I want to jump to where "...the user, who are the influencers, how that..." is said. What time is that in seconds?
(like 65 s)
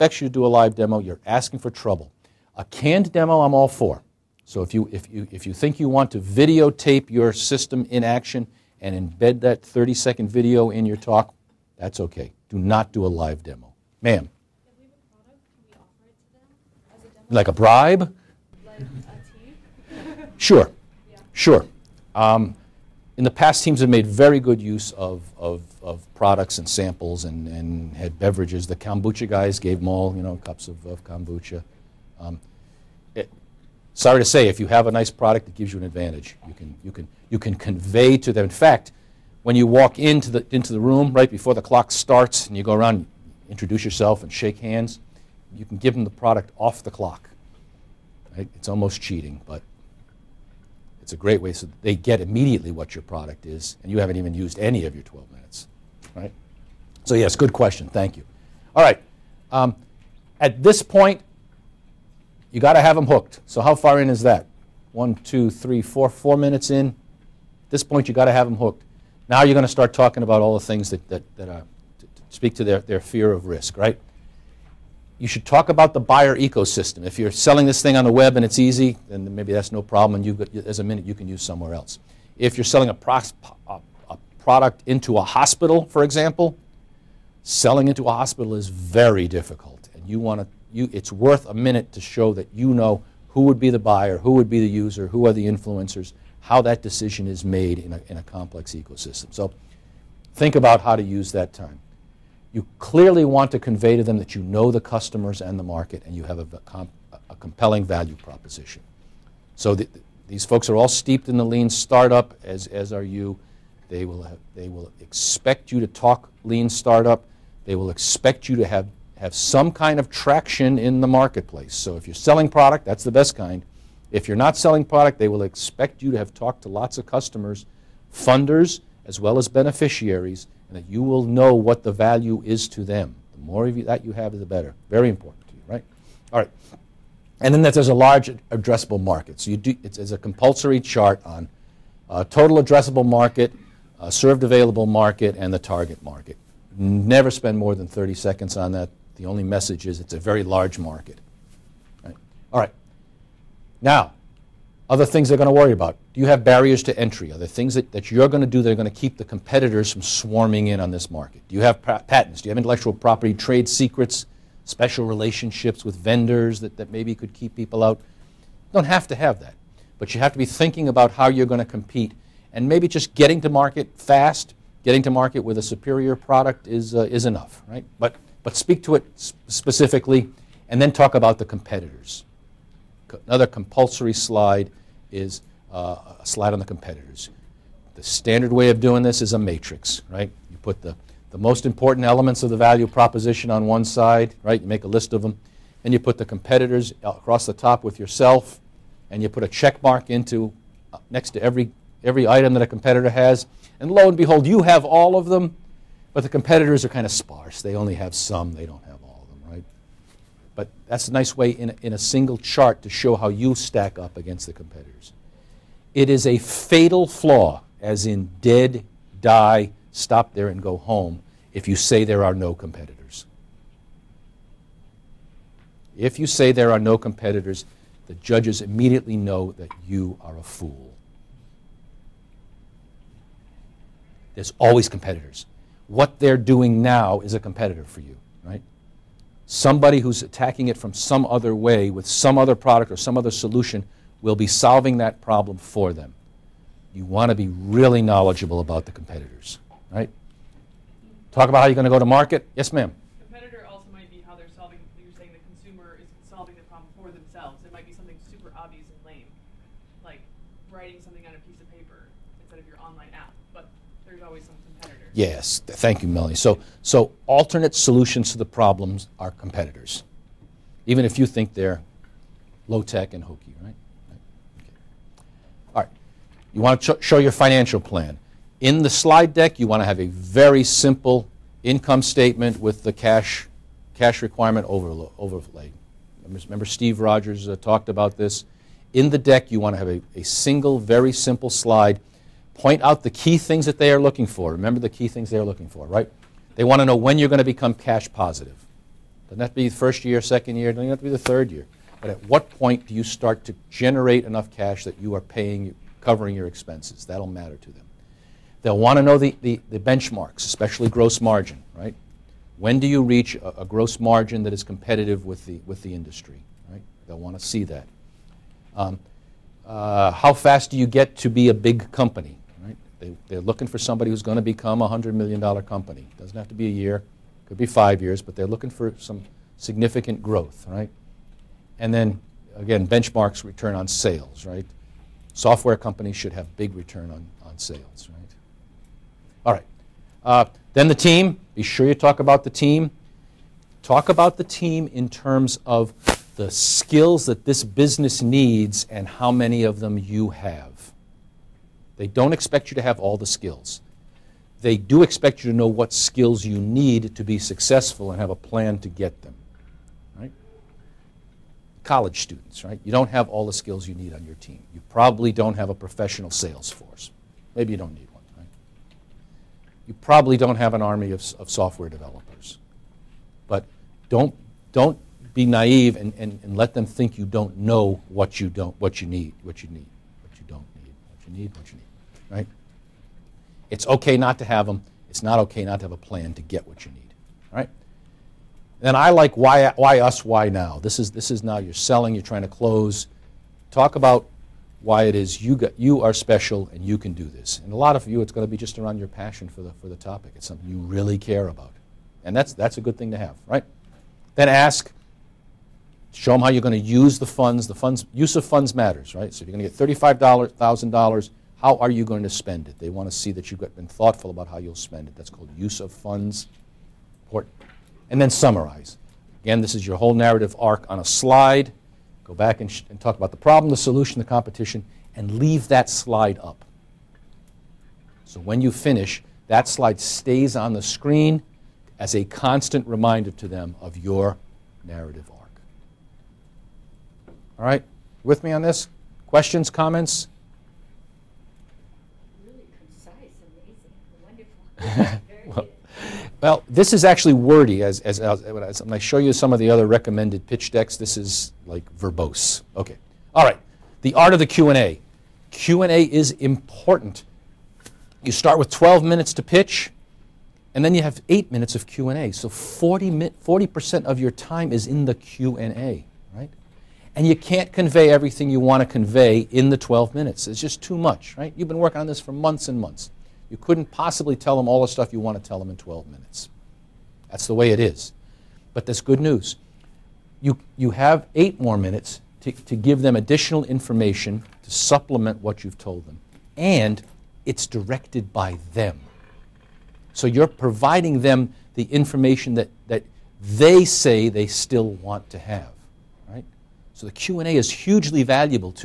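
94 s.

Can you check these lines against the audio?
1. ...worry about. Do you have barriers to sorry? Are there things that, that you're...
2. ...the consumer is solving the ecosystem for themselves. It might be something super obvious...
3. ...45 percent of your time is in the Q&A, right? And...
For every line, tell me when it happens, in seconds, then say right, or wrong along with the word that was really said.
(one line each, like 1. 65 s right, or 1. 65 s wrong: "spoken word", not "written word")
1. 155 s wrong: "entry", not "sorry"
2. 255 s wrong: "problem", not "ecosystem"
3. 462 s wrong: "40", not "45".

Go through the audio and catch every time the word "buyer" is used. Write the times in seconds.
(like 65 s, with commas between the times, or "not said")
75 s, 93 s.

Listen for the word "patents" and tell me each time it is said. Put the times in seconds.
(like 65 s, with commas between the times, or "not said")
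161 s.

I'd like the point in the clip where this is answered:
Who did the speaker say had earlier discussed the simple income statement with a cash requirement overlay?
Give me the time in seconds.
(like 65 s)
286 s.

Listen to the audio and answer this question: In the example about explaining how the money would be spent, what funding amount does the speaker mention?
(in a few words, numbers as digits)
$35,000.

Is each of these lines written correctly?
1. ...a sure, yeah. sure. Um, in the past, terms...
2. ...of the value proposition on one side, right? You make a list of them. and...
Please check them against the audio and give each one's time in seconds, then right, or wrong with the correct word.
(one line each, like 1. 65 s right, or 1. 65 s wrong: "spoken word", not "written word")
1. 18 s wrong: "teams", not "terms"
2. 192 s right.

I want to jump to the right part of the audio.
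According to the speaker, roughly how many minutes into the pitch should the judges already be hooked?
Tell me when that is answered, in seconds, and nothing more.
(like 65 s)
66 s.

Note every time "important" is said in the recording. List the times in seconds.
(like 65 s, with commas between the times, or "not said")
135 s, 191 s, 417 s, 456 s.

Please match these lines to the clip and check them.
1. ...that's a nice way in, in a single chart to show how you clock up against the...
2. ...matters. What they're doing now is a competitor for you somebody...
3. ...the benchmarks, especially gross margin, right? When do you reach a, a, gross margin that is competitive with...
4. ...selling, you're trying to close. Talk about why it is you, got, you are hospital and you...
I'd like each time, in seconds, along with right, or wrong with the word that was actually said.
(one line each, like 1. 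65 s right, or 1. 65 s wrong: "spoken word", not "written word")
1. 210 s wrong: "stack", not "clock"
2. 234 s wrong: "competitors", not "matters"
3. 309 s right
4. 391 s wrong: "special", not "hospital".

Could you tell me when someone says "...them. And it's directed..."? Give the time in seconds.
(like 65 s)
486 s.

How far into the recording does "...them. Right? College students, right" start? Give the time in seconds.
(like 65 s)
359 s.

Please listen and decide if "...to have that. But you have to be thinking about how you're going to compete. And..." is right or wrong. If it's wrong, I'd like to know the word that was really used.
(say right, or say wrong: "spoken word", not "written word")
right.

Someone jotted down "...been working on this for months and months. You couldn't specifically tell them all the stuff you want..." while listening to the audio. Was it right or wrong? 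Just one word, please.
wrong.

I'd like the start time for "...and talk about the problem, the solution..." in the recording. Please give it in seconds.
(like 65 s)
422 s.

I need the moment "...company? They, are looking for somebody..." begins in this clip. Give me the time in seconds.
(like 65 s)
321 s.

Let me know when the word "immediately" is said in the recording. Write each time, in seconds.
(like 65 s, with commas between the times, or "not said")
52 s, 228 s.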